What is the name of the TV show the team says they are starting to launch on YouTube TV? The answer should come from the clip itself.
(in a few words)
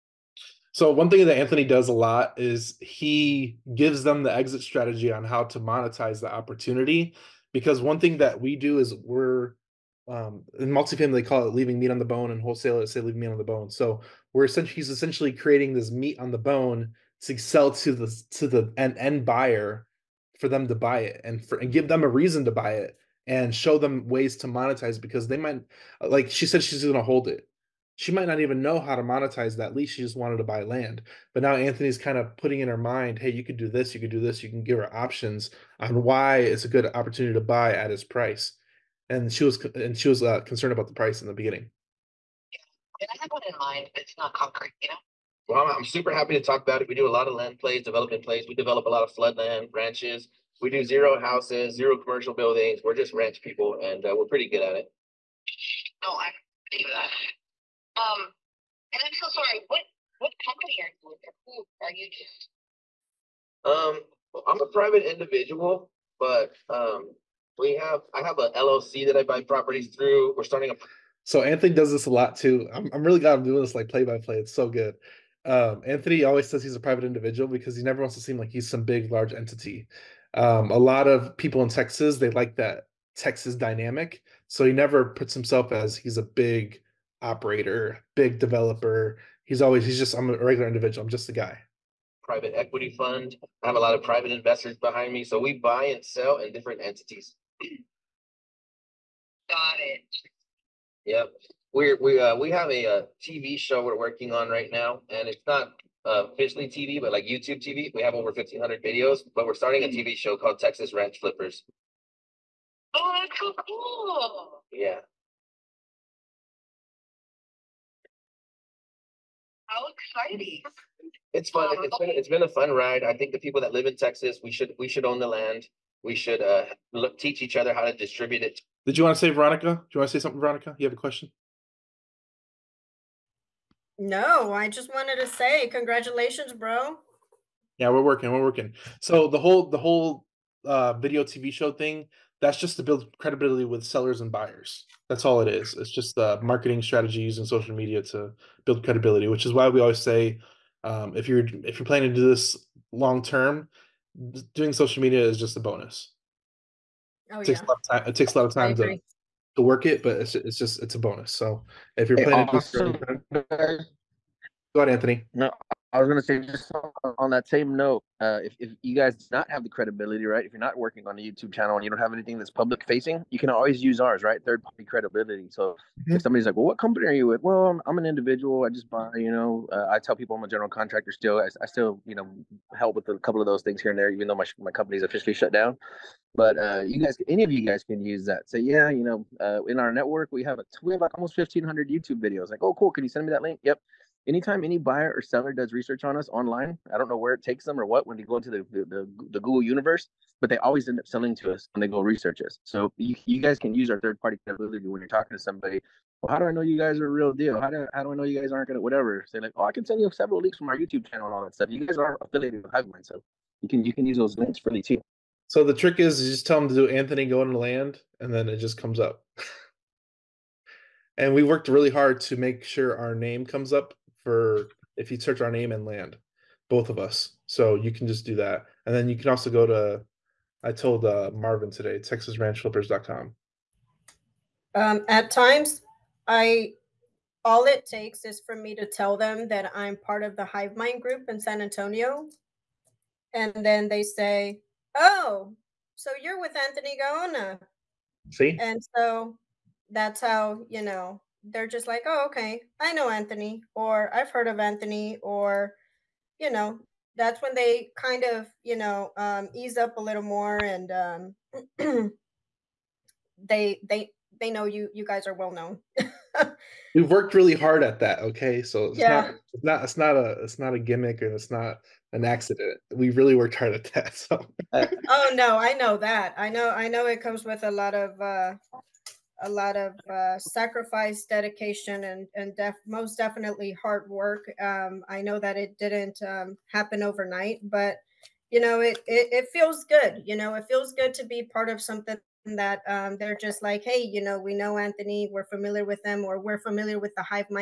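Texas Ranch Flippers.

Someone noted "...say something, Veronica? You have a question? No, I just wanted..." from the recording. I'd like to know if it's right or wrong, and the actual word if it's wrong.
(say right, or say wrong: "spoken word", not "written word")
right.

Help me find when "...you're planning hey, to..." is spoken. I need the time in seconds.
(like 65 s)
162 s.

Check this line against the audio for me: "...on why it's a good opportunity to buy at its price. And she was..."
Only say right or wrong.
right.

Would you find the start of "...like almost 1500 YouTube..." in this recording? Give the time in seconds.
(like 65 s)
191 s.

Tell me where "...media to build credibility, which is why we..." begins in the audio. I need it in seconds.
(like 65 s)
147 s.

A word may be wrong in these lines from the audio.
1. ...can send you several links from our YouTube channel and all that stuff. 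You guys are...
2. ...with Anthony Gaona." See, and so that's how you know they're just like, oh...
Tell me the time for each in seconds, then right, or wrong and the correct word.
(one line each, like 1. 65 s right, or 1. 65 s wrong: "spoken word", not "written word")
1. 209 s right
2. 246 s right.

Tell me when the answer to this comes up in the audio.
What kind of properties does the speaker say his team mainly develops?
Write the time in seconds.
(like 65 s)
49 s.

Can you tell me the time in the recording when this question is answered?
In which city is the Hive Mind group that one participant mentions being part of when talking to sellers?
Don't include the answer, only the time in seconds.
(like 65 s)
241 s.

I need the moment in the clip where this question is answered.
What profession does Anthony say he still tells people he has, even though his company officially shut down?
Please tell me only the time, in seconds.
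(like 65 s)
180 s.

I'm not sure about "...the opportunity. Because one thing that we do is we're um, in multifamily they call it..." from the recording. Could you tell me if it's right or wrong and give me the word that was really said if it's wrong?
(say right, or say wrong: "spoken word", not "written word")
right.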